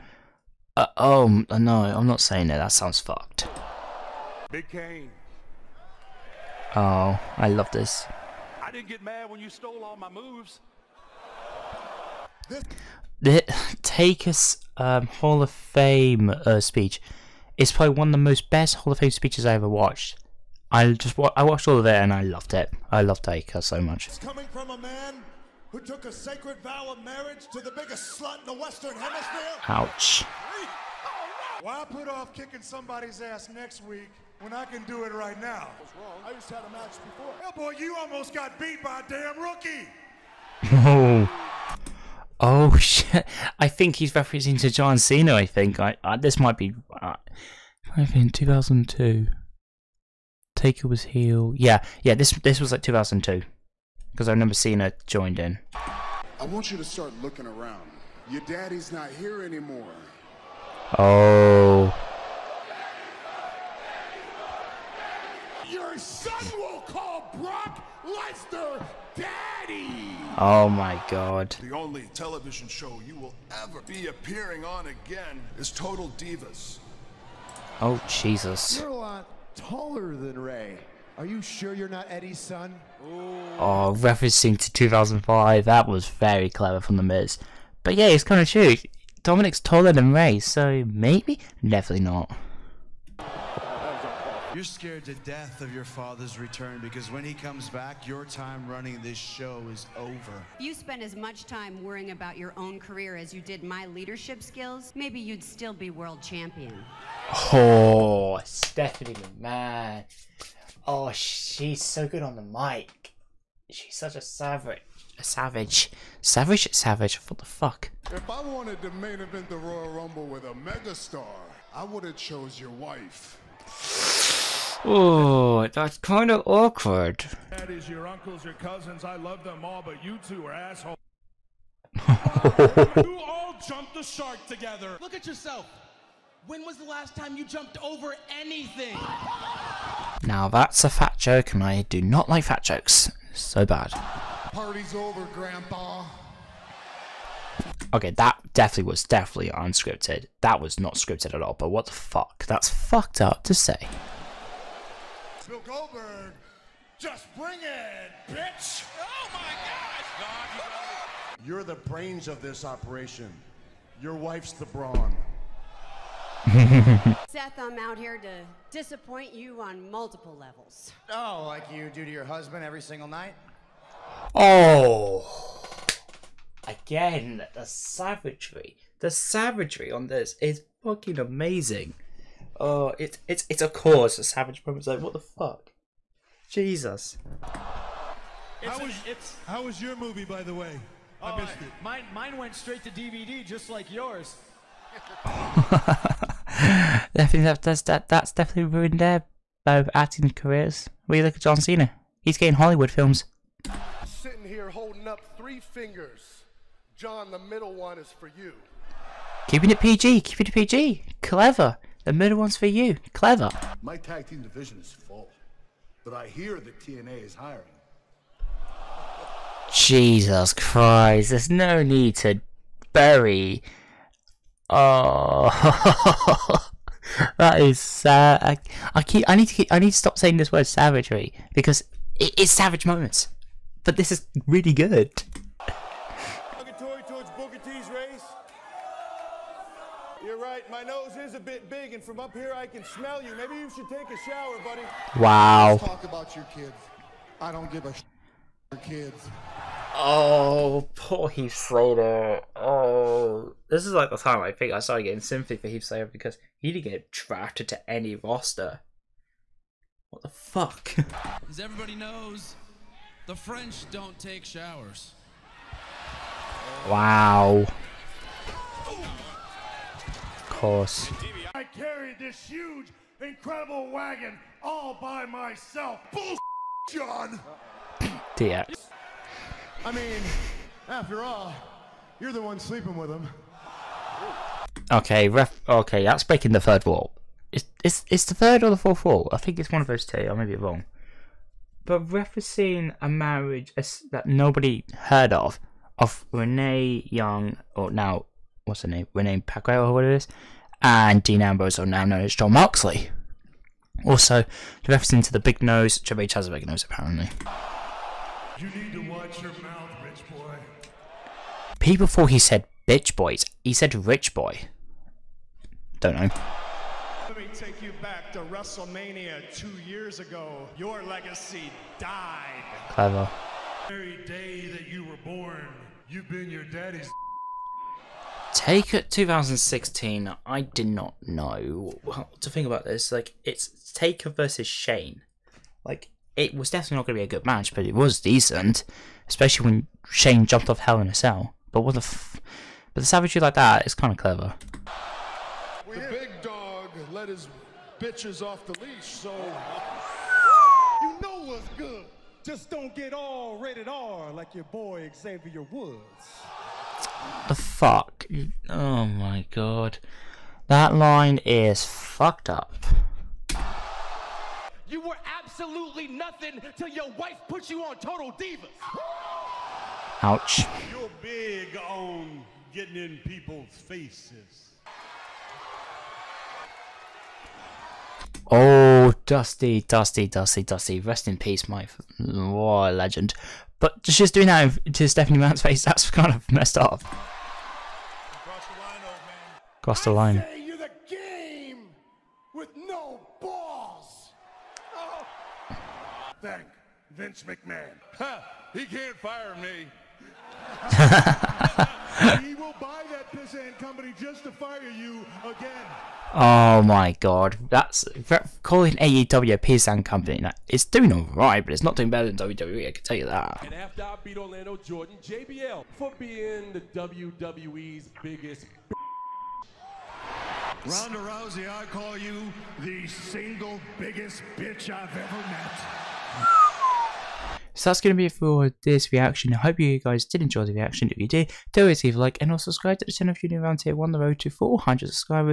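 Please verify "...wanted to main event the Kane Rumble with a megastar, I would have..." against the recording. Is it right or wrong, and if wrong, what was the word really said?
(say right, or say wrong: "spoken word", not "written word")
wrong: "Royal", not "Kane".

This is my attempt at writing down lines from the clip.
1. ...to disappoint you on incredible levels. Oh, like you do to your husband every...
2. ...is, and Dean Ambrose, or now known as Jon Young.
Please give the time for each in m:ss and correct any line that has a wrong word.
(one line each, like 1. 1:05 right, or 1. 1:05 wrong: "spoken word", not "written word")
1. 2:48 wrong: "multiple", not "incredible"
2. 5:00 wrong: "Moxley", not "Young".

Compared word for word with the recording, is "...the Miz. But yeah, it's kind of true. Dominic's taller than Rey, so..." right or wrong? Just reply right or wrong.
right.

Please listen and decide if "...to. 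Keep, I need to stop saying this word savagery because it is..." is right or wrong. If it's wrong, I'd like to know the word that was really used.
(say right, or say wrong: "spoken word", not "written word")
right.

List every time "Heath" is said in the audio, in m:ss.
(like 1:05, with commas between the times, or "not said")
4:11, 4:15.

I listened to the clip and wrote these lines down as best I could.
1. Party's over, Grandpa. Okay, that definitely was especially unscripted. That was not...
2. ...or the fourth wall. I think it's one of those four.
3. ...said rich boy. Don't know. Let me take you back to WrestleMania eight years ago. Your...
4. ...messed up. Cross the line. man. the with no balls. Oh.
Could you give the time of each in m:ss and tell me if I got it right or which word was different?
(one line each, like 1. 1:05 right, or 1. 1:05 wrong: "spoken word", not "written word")
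1. 2:24 wrong: "definitely", not "especially"
2. 4:48 wrong: "two", not "four"
3. 5:13 wrong: "two", not "eight"
4. 6:26 right.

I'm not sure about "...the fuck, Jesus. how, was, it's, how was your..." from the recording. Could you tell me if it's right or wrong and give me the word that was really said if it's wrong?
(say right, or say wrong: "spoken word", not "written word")
right.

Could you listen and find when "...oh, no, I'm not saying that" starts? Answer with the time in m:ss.
0:00.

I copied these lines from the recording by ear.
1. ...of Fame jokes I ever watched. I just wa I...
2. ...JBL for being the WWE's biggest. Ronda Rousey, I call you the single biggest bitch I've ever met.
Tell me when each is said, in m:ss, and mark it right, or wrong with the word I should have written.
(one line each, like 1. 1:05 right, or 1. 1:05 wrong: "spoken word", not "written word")
1. 0:18 wrong: "speeches", not "jokes"
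2. 6:55 right.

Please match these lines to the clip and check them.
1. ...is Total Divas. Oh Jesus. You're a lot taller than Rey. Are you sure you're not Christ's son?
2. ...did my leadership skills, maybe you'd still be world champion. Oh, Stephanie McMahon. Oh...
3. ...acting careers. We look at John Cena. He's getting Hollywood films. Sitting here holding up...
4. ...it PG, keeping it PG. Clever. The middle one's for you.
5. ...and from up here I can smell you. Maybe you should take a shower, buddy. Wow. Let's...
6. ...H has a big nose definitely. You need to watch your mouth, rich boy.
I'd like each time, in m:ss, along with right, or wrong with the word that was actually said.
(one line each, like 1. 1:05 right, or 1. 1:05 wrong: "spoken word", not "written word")
1. 1:15 wrong: "Eddie", not "Christ"
2. 1:43 right
3. 3:19 right
4. 3:29 right
5. 4:01 right
6. 5:06 wrong: "apparently", not "definitely".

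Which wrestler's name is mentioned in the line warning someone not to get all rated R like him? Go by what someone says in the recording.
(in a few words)
Xavier Woods.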